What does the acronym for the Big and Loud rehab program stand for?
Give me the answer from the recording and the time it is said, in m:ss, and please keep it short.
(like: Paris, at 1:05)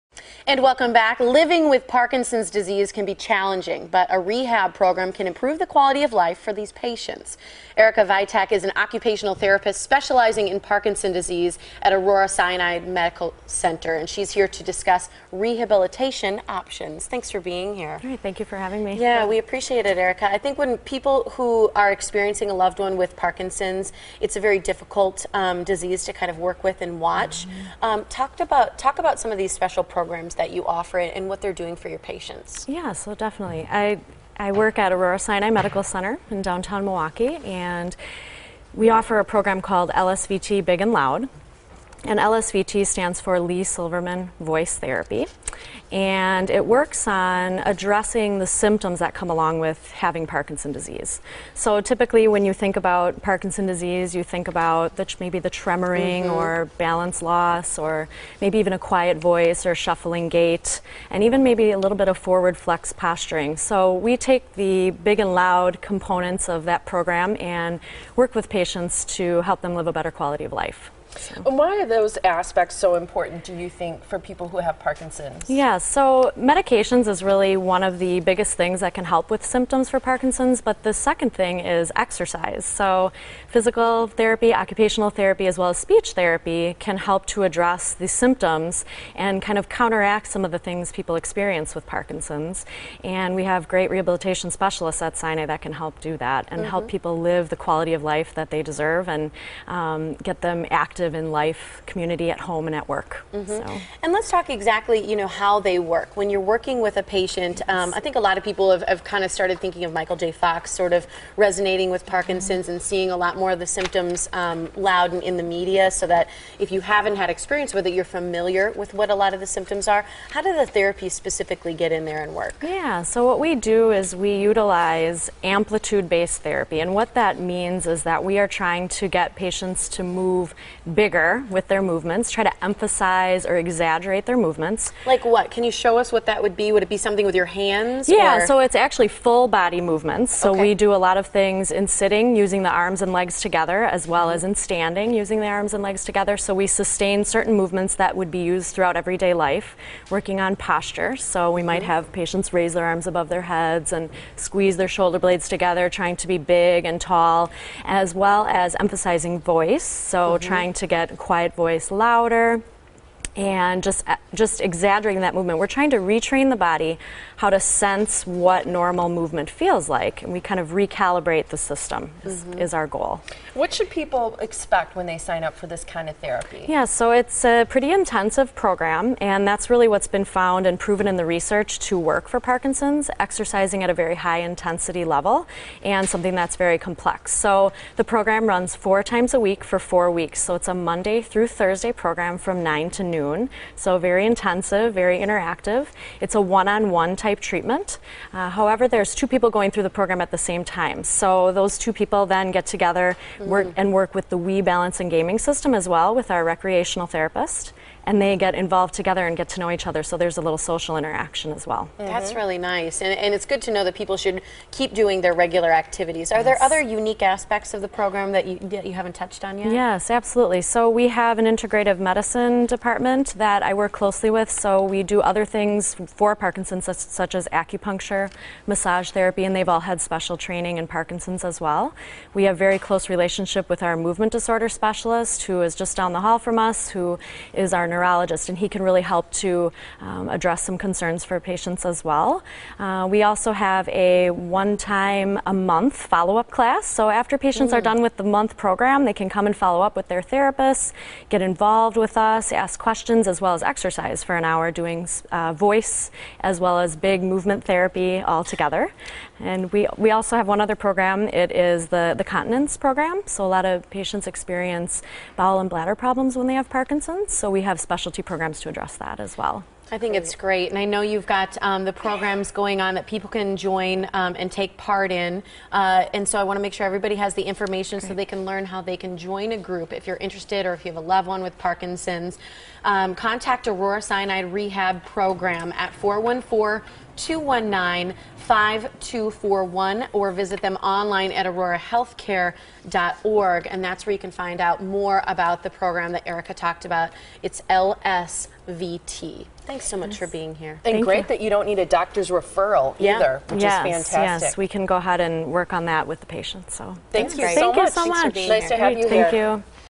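Lee Silverman Voice Therapy, at 0:43.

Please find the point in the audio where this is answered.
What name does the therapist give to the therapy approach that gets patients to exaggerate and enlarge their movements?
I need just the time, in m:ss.
2:05.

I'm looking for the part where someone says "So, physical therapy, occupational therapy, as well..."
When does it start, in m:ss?
1:22.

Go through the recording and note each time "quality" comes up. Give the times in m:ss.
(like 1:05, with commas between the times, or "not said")
0:05, 1:10, 1:37.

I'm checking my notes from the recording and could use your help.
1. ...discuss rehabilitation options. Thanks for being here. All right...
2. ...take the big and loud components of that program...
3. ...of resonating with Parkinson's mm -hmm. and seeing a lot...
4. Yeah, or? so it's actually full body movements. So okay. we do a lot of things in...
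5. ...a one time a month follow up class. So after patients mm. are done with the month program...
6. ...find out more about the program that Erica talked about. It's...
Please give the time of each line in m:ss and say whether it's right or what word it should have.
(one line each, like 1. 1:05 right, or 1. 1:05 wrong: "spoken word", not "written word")
1. 0:14 right
2. 1:04 right
3. 1:50 right
4. 2:18 right
5. 4:03 right
6. 4:54 right.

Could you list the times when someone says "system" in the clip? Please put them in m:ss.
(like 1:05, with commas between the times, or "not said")
2:51, 3:25.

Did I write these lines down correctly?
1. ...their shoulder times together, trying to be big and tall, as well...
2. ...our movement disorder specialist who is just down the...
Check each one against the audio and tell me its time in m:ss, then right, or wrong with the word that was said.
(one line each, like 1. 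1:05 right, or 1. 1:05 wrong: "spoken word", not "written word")
1. 2:34 wrong: "blades", not "times"
2. 3:53 right.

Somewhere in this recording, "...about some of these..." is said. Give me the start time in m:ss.
0:28.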